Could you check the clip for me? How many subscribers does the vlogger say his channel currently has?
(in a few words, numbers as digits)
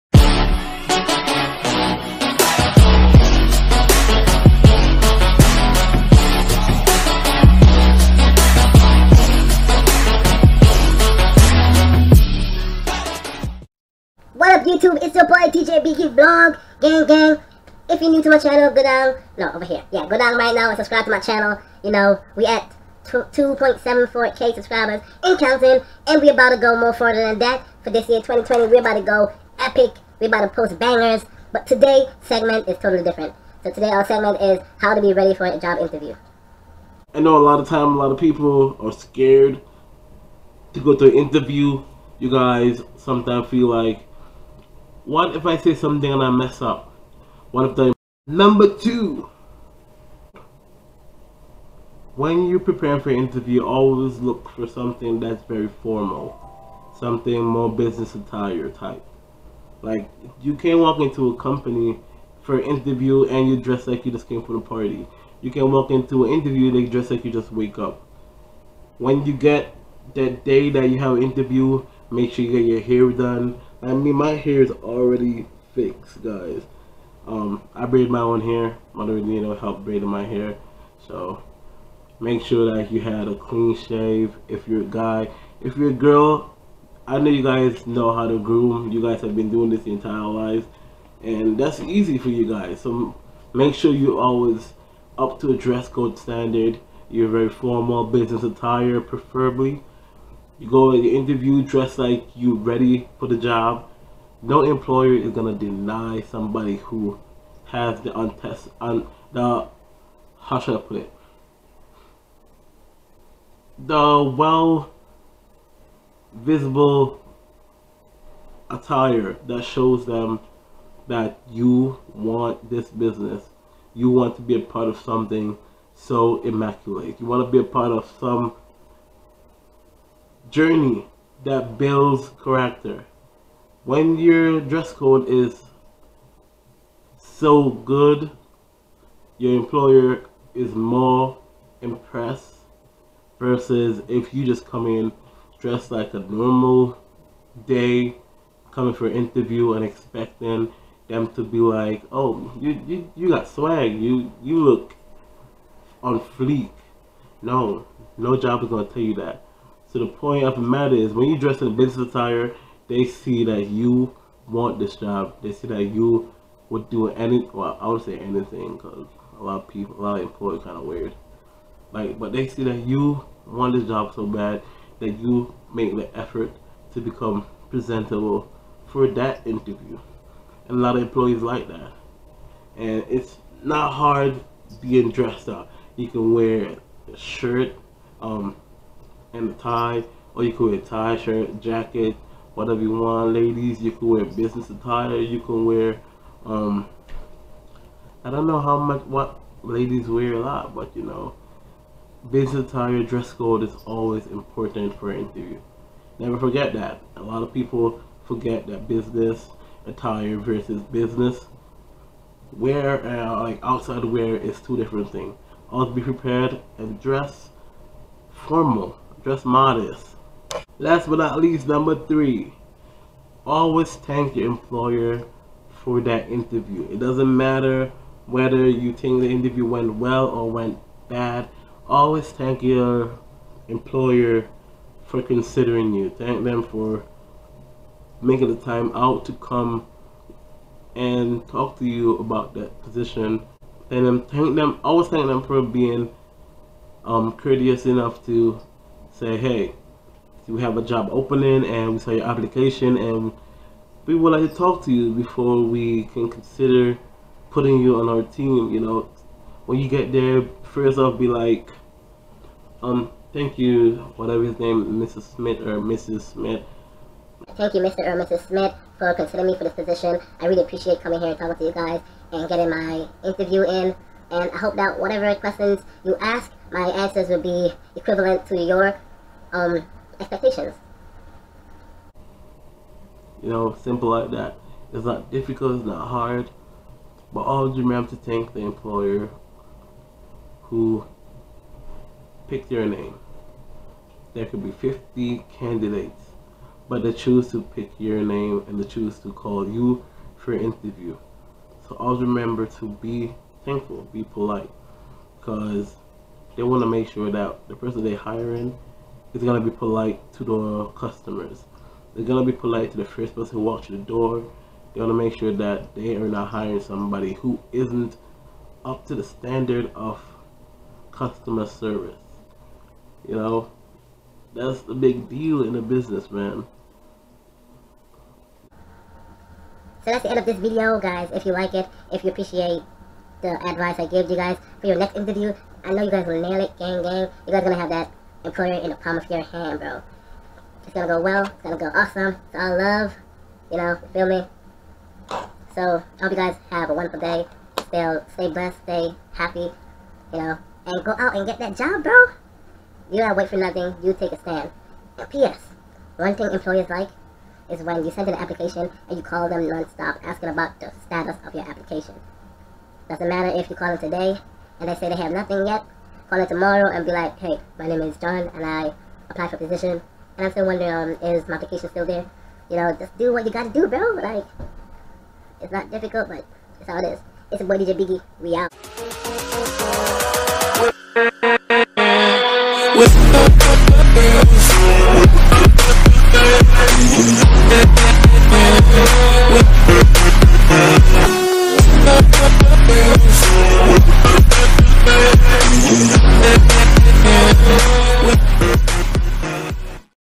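2.74k.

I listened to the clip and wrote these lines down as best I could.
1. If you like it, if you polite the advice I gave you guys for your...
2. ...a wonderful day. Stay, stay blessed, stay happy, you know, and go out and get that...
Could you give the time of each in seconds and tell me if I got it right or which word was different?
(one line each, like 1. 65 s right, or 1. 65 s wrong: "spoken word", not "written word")
1. 331 s wrong: "appreciate", not "polite"
2. 346 s right.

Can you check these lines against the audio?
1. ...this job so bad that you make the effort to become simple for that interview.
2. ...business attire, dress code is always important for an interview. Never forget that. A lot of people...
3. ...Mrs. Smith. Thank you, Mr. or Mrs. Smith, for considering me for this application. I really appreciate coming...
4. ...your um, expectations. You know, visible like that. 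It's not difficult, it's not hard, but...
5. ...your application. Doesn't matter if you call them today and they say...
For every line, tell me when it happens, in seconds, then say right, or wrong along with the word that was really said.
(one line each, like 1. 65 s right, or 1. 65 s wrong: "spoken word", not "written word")
1. 173 s wrong: "presentable", not "simple"
2. 202 s right
3. 265 s wrong: "position", not "application"
4. 278 s wrong: "simple", not "visible"
5. 361 s right.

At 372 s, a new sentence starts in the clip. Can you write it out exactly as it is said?
You know, just do what you gotta do, bro.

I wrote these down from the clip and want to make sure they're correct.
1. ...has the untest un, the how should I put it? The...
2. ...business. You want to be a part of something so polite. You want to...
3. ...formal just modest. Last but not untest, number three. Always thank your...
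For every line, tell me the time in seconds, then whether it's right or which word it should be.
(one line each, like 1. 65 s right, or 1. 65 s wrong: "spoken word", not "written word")
1. 107 s right
2. 122 s wrong: "immaculate", not "polite"
3. 218 s wrong: "least", not "untest".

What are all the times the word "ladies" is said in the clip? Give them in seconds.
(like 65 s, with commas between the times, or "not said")
193 s, 199 s.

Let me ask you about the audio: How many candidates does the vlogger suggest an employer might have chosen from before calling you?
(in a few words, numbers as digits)
50.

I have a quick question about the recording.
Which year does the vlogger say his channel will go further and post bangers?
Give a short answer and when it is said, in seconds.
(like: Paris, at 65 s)
2020, at 28 s.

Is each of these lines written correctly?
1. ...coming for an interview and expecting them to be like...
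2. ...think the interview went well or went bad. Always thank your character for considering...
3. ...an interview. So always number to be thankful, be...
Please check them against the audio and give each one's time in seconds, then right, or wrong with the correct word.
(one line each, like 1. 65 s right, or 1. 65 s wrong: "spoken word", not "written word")
1. 148 s right
2. 228 s wrong: "employer", not "character"
3. 300 s wrong: "remember", not "number".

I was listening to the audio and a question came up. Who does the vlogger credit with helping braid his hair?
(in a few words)
Mother Nino.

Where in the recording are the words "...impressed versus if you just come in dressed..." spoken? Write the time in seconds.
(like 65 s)
141 s.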